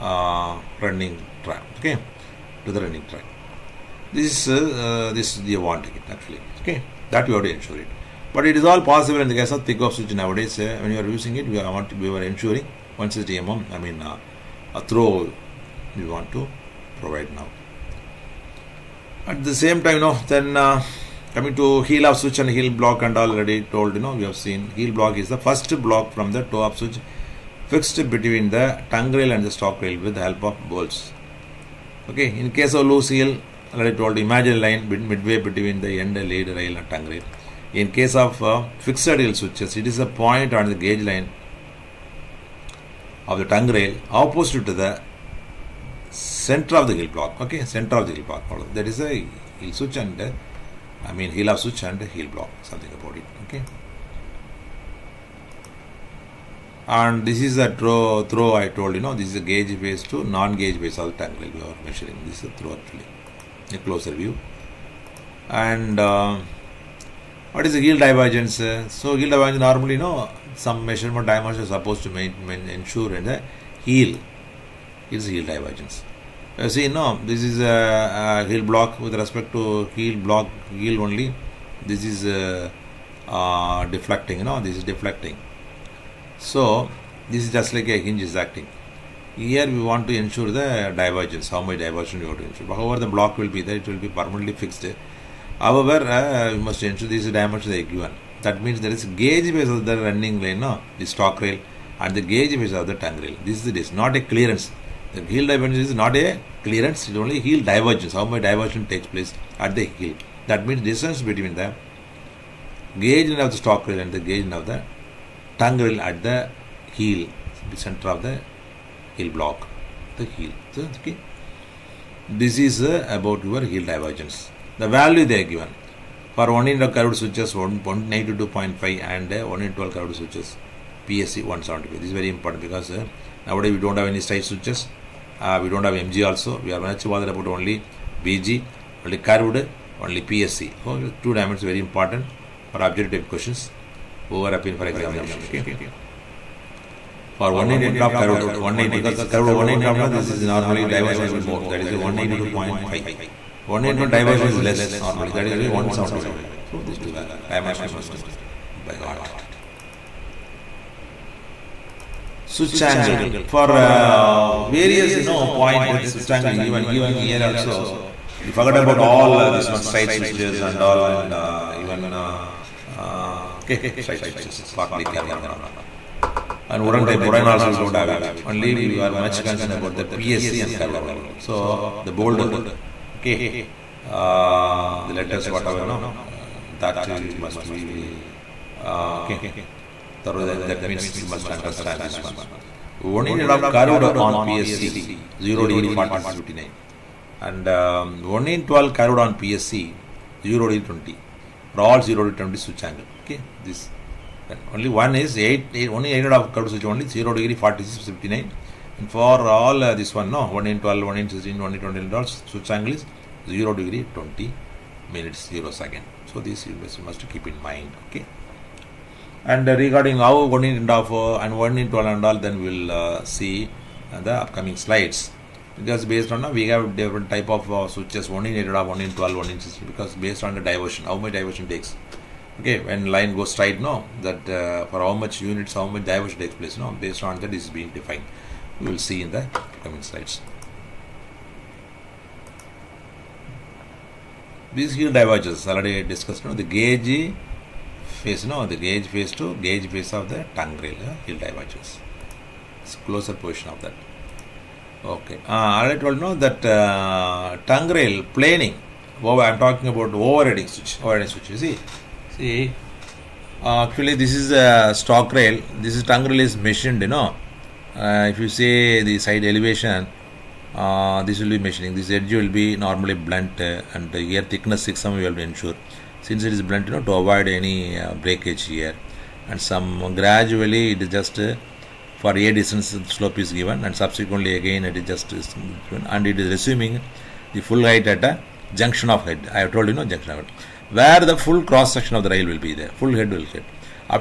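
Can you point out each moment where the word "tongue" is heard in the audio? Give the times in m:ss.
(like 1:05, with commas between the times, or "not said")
0:28, 0:36, 0:43, 1:43, 1:55, 4:10, 4:17, 4:26.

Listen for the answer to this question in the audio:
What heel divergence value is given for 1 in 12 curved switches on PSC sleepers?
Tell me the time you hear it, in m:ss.
2:09.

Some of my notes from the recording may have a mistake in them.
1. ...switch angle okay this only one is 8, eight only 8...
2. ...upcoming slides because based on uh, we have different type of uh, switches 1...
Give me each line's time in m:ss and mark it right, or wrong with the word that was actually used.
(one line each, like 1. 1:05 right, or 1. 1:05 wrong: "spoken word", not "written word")
1. 3:22 right
2. 3:44 right.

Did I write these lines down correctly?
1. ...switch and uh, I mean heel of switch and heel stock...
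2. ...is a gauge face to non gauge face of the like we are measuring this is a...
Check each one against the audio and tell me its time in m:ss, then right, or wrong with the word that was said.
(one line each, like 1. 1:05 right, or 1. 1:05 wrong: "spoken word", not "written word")
1. 0:49 wrong: "block", not "stock"
2. 0:59 right.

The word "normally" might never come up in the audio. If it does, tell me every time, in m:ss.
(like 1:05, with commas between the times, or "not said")
1:09, 2:30, 2:35, 4:32.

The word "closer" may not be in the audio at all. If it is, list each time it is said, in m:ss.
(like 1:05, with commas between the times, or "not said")
1:03, 4:13.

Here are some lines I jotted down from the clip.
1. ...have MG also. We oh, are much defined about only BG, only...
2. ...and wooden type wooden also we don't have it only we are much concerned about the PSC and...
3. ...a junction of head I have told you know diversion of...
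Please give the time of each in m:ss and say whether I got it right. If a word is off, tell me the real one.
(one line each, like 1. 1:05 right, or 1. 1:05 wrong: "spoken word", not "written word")
1. 2:15 wrong: "bothered", not "defined"
2. 2:56 right
3. 4:48 wrong: "junction", not "diversion".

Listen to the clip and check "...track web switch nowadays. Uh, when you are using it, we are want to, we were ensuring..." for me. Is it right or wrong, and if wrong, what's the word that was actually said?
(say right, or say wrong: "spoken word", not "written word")
wrong: "thick", not "track".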